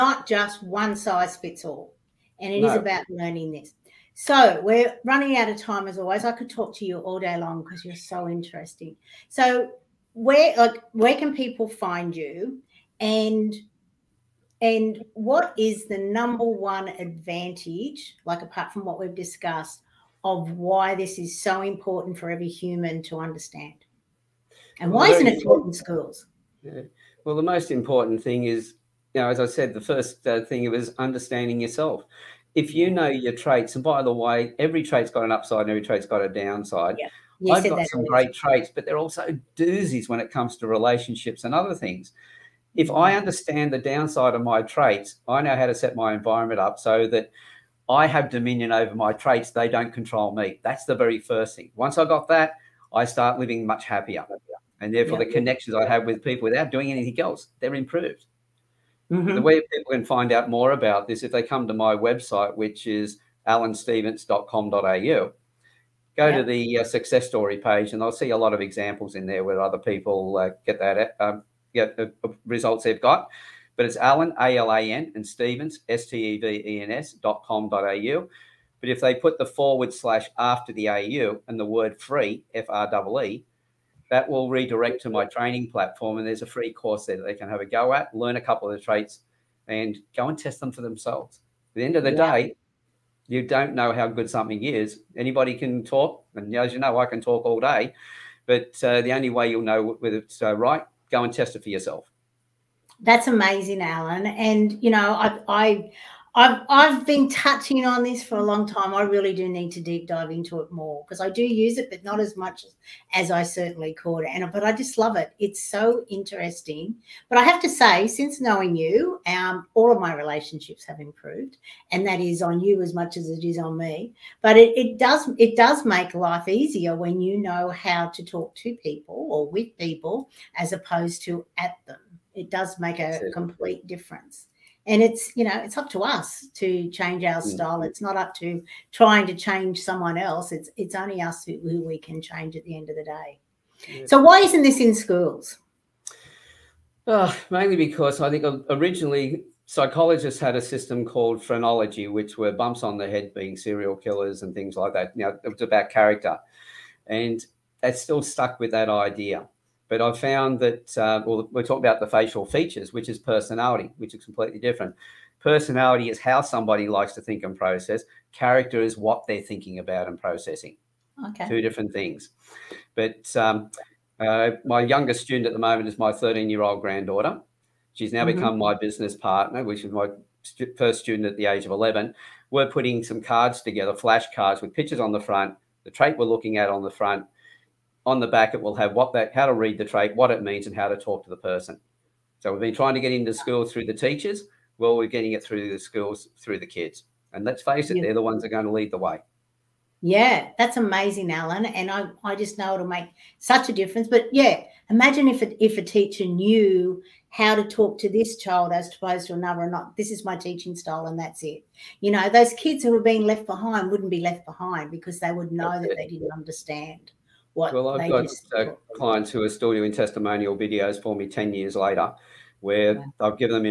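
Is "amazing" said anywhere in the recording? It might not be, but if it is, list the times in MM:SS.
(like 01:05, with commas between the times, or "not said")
01:43, 03:20.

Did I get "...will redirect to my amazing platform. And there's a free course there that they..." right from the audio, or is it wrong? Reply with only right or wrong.
wrong.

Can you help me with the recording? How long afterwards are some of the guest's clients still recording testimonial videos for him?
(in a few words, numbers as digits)
10 years.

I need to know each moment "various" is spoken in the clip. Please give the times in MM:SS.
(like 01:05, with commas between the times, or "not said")
not said.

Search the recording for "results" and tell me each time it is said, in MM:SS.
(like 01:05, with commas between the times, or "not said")
01:12.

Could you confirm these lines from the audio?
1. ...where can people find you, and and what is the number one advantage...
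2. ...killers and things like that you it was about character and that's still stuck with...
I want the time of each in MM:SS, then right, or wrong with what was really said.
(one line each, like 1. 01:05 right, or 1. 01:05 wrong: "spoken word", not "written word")
1. 00:10 right
2. 02:33 right.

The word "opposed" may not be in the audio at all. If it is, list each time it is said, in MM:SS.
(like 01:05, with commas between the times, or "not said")
02:10, 03:28.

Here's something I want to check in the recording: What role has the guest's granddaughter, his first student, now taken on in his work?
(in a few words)
Business partner.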